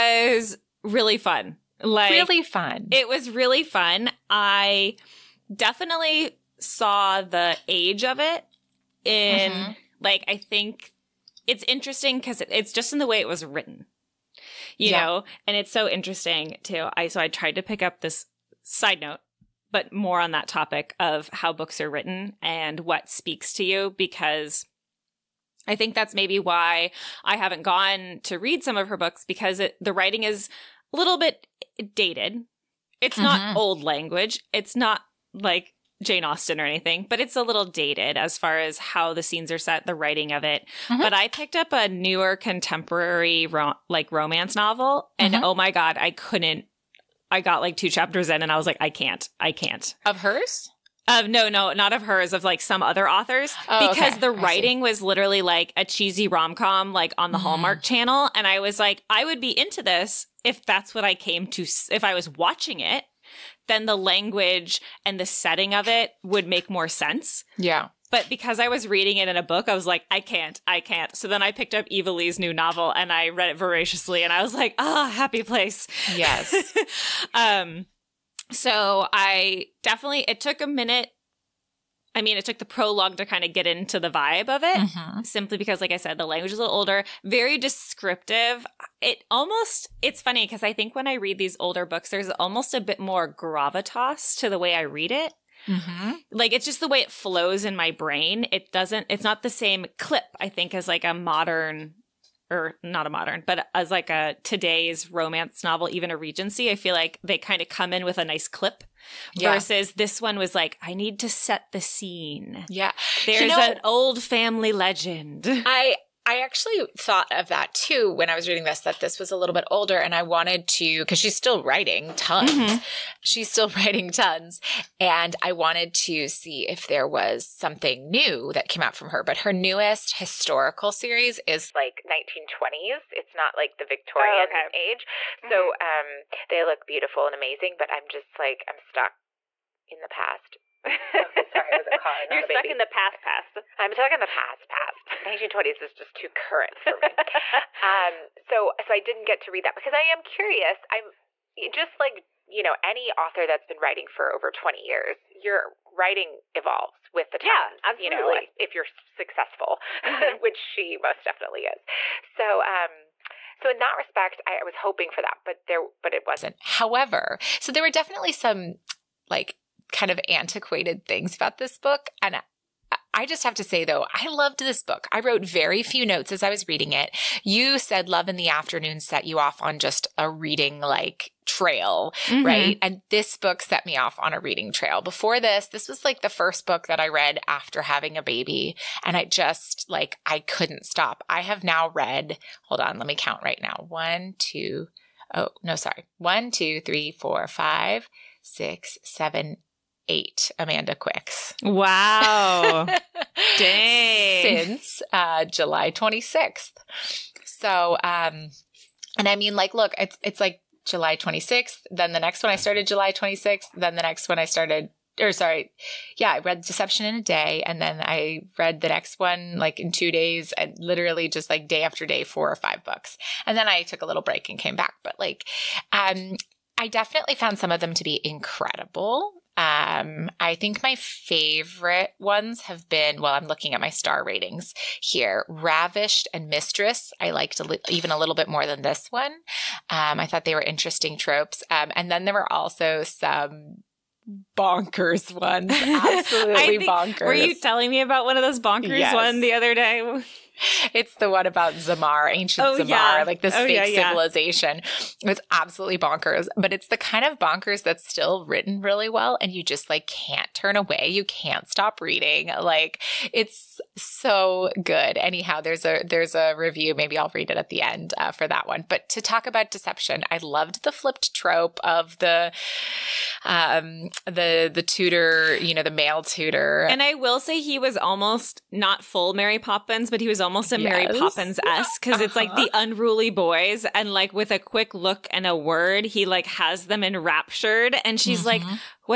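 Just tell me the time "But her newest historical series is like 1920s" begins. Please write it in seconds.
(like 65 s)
129 s.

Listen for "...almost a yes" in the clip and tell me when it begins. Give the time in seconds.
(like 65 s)
280 s.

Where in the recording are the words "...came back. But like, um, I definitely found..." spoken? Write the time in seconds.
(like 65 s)
224 s.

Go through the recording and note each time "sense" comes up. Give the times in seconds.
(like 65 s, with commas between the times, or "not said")
66 s.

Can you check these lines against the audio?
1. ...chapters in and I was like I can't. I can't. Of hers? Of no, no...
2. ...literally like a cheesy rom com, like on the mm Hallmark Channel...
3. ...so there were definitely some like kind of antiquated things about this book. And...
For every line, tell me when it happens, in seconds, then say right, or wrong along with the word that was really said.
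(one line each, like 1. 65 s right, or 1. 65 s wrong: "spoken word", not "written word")
1. 47 s right
2. 55 s right
3. 167 s right.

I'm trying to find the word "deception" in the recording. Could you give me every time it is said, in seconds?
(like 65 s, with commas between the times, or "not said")
216 s, 269 s.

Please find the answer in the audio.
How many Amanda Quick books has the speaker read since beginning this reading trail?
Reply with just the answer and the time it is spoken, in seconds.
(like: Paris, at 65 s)
8, at 200 s.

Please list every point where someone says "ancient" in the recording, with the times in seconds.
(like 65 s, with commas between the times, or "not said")
252 s.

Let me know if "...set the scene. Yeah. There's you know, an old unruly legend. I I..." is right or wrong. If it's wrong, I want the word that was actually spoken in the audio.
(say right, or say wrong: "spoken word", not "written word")
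wrong: "family", not "unruly".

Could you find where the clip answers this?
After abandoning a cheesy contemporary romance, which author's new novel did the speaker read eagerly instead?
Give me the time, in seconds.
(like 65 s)
71 s.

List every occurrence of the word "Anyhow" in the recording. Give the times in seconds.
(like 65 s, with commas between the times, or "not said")
265 s.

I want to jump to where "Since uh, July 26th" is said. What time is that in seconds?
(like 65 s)
204 s.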